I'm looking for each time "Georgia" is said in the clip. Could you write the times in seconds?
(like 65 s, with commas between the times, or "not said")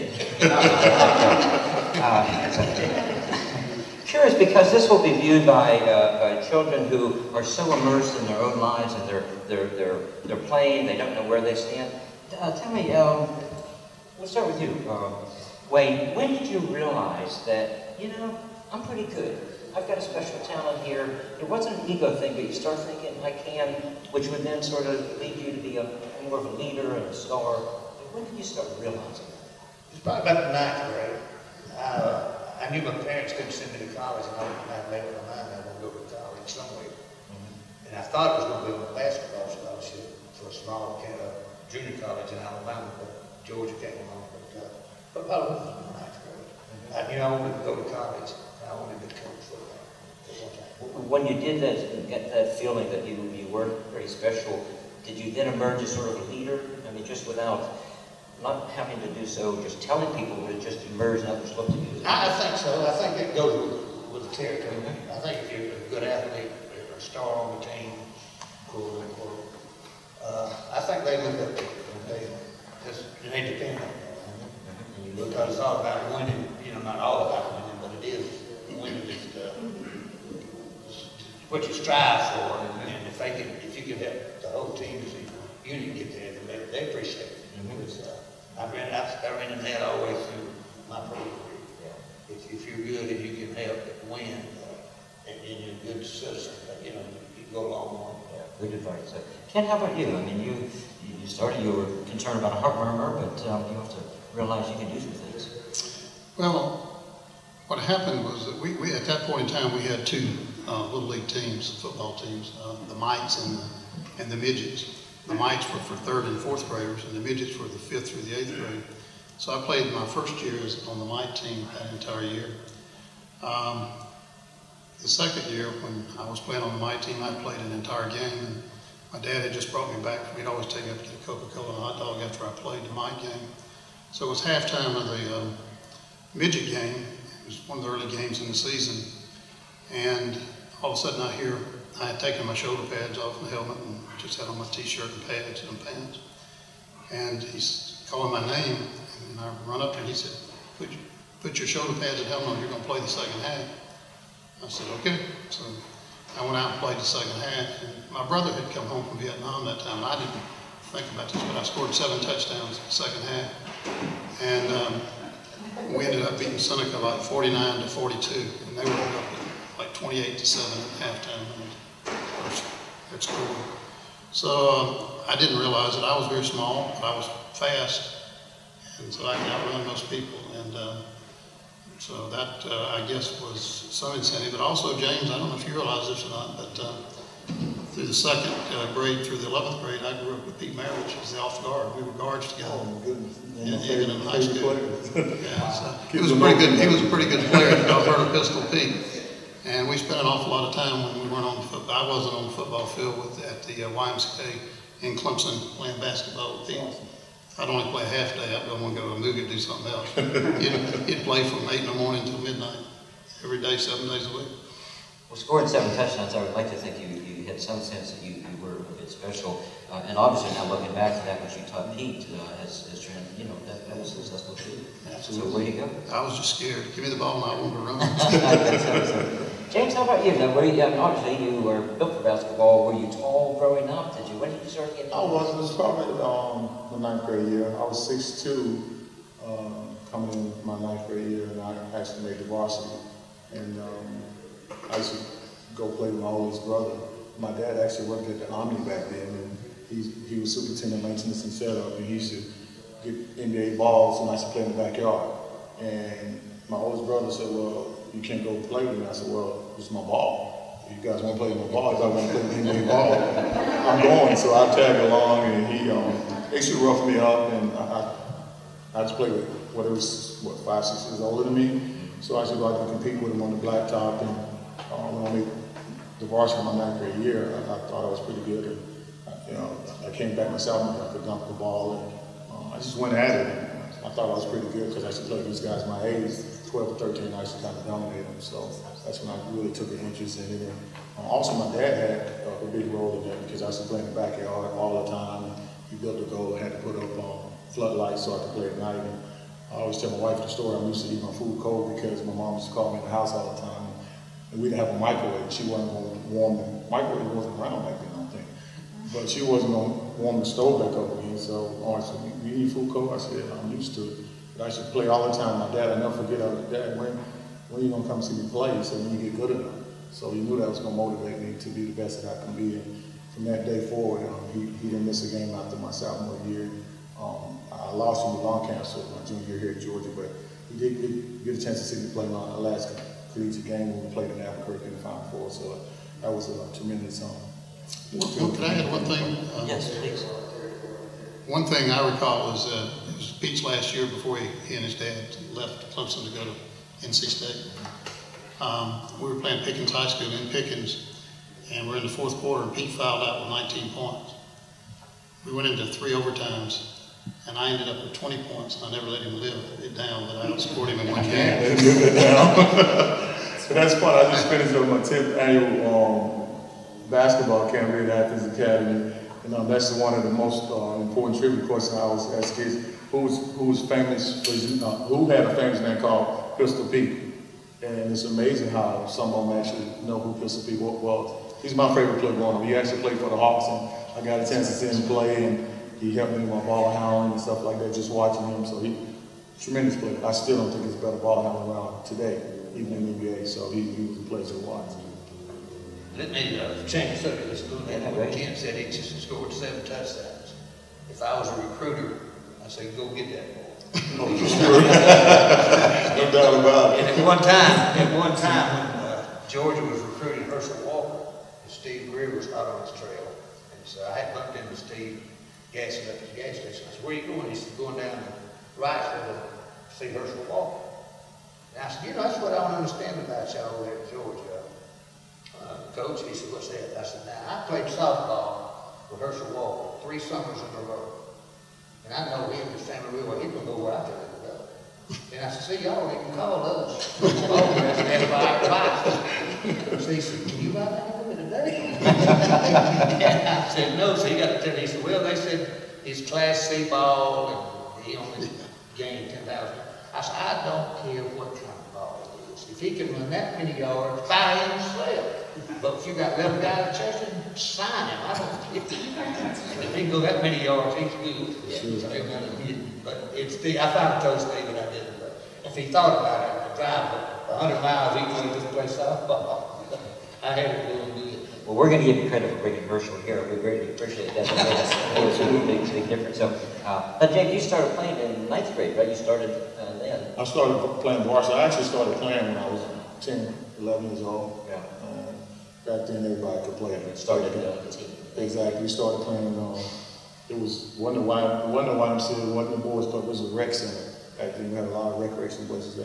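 43 s, 329 s, 409 s, 424 s.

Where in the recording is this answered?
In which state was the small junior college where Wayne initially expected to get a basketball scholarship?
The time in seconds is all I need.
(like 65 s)
42 s.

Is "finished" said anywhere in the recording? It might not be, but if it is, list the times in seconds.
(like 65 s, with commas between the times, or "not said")
364 s.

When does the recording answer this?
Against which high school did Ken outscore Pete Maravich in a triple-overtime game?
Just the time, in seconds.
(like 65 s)
349 s.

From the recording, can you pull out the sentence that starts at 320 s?
So he knew that was going to motivate me to be the best that I can be.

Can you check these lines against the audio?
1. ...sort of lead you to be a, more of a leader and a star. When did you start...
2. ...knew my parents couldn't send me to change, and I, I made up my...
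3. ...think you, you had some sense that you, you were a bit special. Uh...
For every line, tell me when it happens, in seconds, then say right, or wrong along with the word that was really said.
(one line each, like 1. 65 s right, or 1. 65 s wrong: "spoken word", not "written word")
1. 24 s right
2. 32 s wrong: "college", not "change"
3. 216 s right.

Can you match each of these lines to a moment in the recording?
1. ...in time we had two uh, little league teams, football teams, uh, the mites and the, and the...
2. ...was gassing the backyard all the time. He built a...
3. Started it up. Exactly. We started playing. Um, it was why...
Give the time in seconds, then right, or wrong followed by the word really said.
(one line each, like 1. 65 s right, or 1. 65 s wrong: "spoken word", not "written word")
1. 109 s right
2. 293 s wrong: "playing", not "gassing"
3. 487 s right.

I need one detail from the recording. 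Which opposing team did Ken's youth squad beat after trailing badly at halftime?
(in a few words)
Seneca.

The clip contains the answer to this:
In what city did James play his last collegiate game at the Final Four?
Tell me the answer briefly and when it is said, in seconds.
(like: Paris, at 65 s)
Albuquerque, at 334 s.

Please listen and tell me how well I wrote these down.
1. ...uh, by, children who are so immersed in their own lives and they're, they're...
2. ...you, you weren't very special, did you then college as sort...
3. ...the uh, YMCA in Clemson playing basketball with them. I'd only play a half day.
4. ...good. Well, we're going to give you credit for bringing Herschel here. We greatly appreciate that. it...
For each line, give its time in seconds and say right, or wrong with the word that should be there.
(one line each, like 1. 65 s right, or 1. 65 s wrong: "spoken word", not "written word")
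1. 5 s right
2. 53 s wrong: "emerge", not "college"
3. 203 s right
4. 471 s right.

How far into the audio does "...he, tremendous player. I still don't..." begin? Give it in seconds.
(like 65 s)
388 s.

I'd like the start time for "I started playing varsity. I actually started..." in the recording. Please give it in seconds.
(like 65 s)
480 s.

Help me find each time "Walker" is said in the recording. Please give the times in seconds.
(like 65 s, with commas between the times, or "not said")
410 s, 420 s, 429 s.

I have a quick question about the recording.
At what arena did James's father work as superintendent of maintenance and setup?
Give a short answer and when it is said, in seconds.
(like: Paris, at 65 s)
the Omni, at 248 s.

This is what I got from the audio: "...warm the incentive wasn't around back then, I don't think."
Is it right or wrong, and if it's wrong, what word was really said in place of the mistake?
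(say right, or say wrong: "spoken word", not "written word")
wrong: "microwave", not "incentive".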